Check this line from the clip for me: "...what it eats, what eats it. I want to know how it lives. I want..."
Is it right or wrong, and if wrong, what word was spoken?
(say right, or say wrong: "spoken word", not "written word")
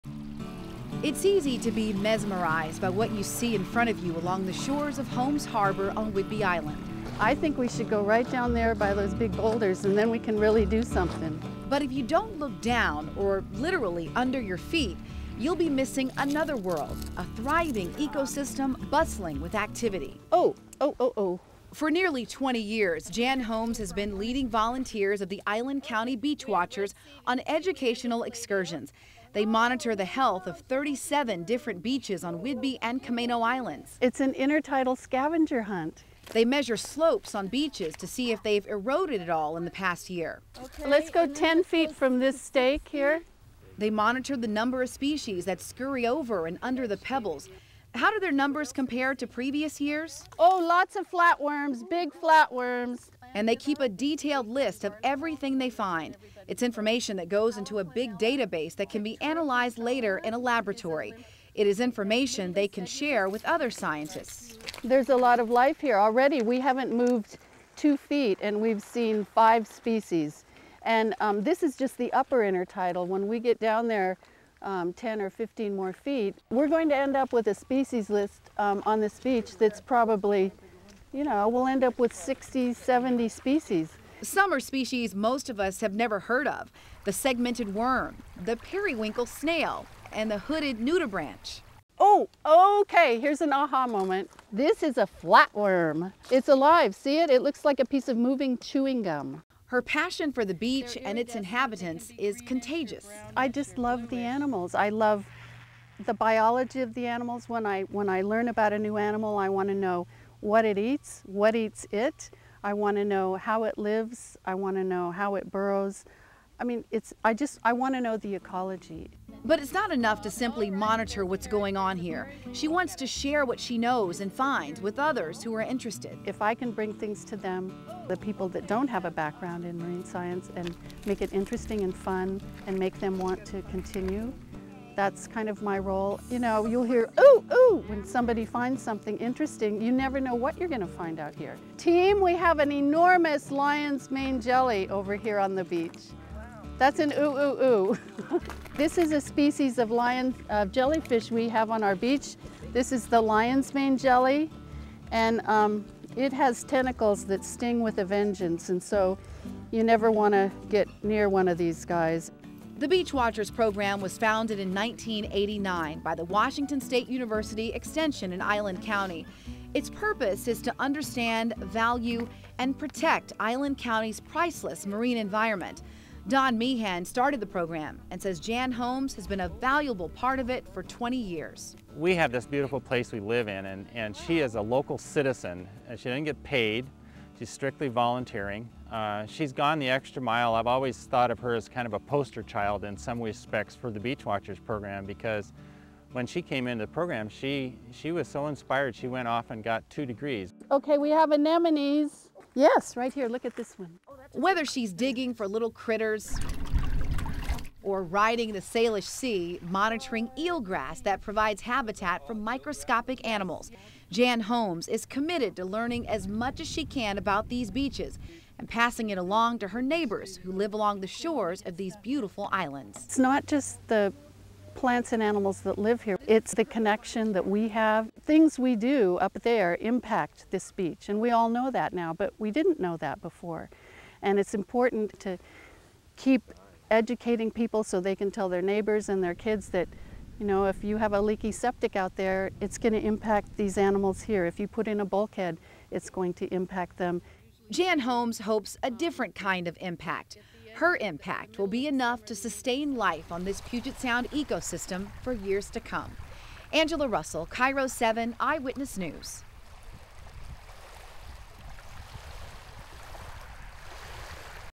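right.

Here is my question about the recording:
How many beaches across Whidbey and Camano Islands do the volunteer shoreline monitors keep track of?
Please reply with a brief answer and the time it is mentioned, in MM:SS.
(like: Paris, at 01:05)
37, at 00:30.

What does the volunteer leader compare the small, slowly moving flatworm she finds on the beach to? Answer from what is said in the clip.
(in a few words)
moving chewing gum.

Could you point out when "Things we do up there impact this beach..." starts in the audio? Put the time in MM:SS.
03:48.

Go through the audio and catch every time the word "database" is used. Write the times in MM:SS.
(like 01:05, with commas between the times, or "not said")
00:58.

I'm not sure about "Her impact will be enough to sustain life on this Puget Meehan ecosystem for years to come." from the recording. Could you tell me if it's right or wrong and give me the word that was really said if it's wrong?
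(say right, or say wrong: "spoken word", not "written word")
wrong: "Sound", not "Meehan".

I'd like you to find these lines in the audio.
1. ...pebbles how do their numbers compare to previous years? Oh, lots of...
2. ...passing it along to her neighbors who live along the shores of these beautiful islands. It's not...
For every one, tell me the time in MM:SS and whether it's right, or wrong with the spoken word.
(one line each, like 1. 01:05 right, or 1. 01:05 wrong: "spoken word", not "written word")
1. 00:46 right
2. 03:38 right.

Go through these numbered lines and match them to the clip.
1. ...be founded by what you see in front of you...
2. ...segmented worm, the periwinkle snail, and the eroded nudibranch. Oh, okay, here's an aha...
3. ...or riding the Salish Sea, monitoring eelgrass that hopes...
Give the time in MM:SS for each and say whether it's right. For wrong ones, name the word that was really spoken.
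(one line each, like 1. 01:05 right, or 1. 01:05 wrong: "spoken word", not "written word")
1. 00:01 wrong: "mesmerized", not "founded"
2. 01:27 wrong: "hooded", not "eroded"
3. 03:27 wrong: "provides", not "hopes".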